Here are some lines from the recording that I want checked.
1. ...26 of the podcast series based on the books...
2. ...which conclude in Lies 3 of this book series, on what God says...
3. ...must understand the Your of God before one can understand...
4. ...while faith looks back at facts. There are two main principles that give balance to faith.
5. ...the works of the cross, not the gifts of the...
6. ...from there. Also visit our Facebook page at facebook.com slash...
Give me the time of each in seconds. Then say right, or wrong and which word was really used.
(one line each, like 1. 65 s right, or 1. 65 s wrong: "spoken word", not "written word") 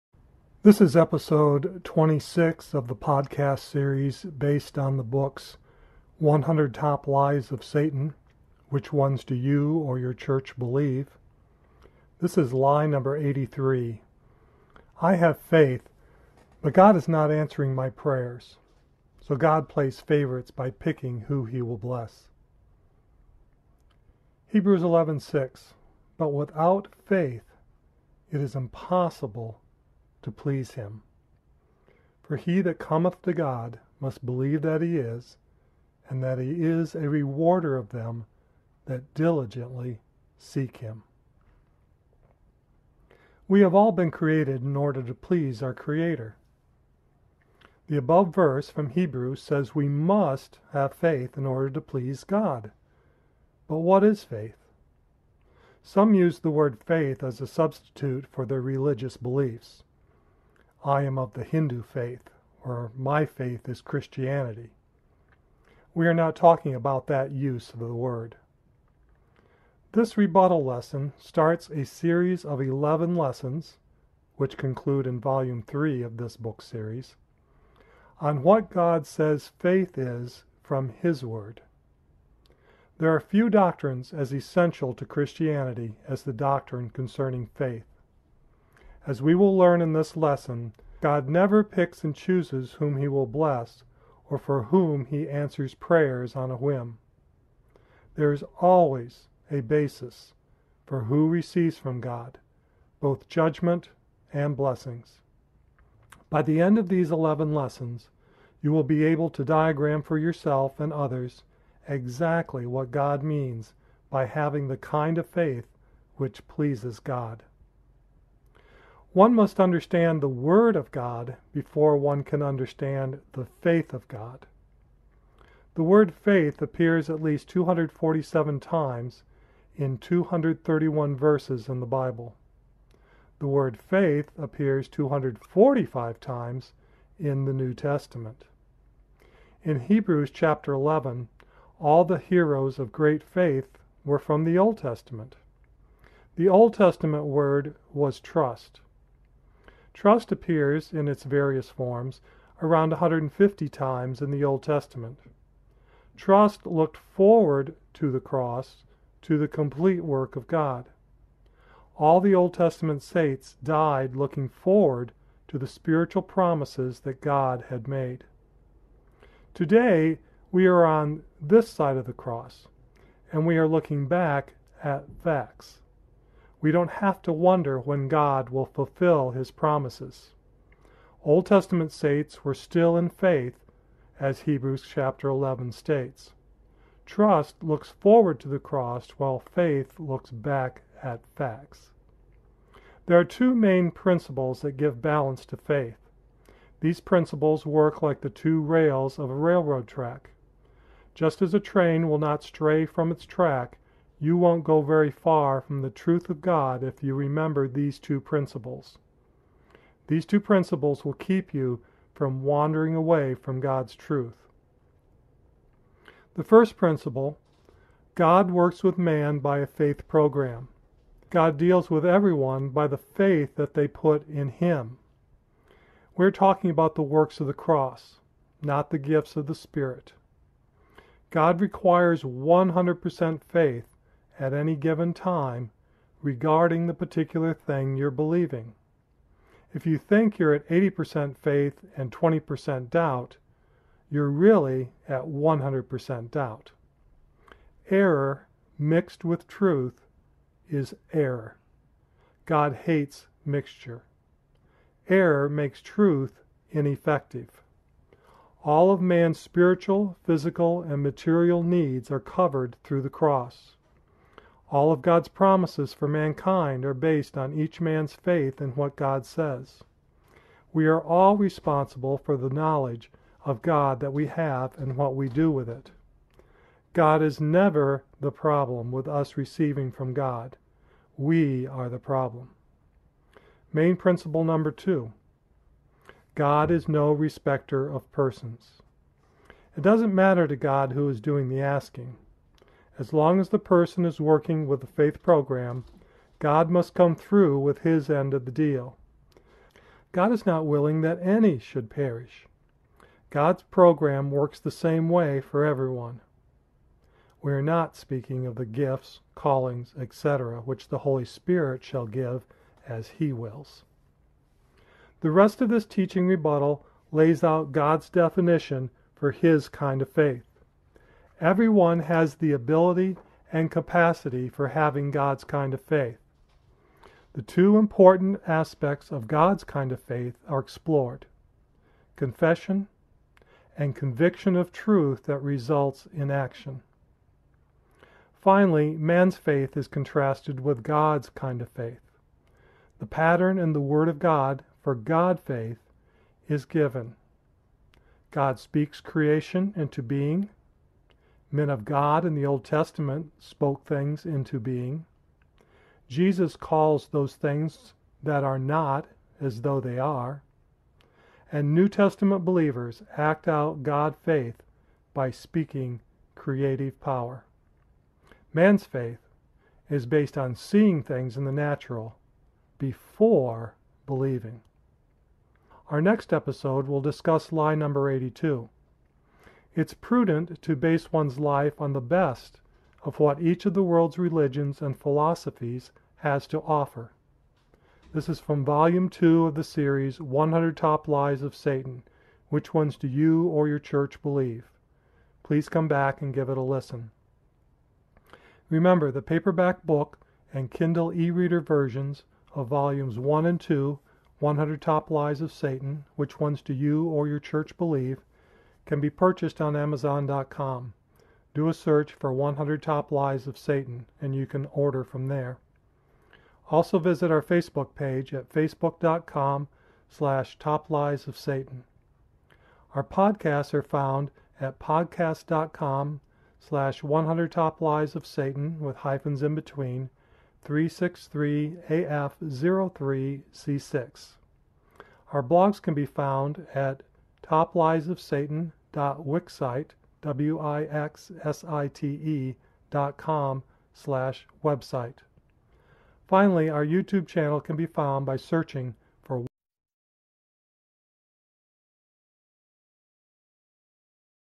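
1. 1 s right
2. 74 s wrong: "Volume", not "Lies"
3. 119 s wrong: "Word", not "Your"
4. 189 s right
5. 226 s right
6. 415 s right.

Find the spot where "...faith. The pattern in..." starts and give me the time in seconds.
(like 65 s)
341 s.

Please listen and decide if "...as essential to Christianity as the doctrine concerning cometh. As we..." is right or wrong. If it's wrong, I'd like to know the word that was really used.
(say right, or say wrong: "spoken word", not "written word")
wrong: "faith", not "cometh".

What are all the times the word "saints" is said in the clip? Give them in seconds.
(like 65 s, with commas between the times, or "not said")
163 s, 181 s.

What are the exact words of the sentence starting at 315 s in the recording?
The rest of this teaching rebuttal lays out God's definition for His kind of faith.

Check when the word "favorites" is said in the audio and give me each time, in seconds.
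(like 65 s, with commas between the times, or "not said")
19 s.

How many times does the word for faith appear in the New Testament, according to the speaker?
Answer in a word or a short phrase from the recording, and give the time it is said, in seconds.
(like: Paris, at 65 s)
245, at 134 s.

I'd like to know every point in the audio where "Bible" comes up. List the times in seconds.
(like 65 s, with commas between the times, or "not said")
131 s.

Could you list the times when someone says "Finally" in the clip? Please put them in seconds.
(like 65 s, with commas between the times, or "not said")
338 s, 446 s.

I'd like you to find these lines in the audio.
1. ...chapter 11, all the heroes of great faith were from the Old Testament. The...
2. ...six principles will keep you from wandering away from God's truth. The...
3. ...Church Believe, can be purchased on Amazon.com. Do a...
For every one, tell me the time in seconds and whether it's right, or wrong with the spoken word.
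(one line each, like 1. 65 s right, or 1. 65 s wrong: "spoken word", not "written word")
1. 140 s right
2. 210 s wrong: "two", not "six"
3. 407 s right.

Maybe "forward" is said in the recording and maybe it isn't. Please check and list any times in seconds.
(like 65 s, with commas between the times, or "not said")
156 s, 164 s, 187 s.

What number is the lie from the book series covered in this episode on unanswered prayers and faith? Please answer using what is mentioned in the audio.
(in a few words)
83.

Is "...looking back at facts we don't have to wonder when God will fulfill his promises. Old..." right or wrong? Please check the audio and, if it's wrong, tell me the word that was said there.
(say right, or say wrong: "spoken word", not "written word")
right.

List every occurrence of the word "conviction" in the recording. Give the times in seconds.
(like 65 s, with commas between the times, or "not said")
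333 s.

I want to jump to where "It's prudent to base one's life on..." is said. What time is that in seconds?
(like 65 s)
379 s.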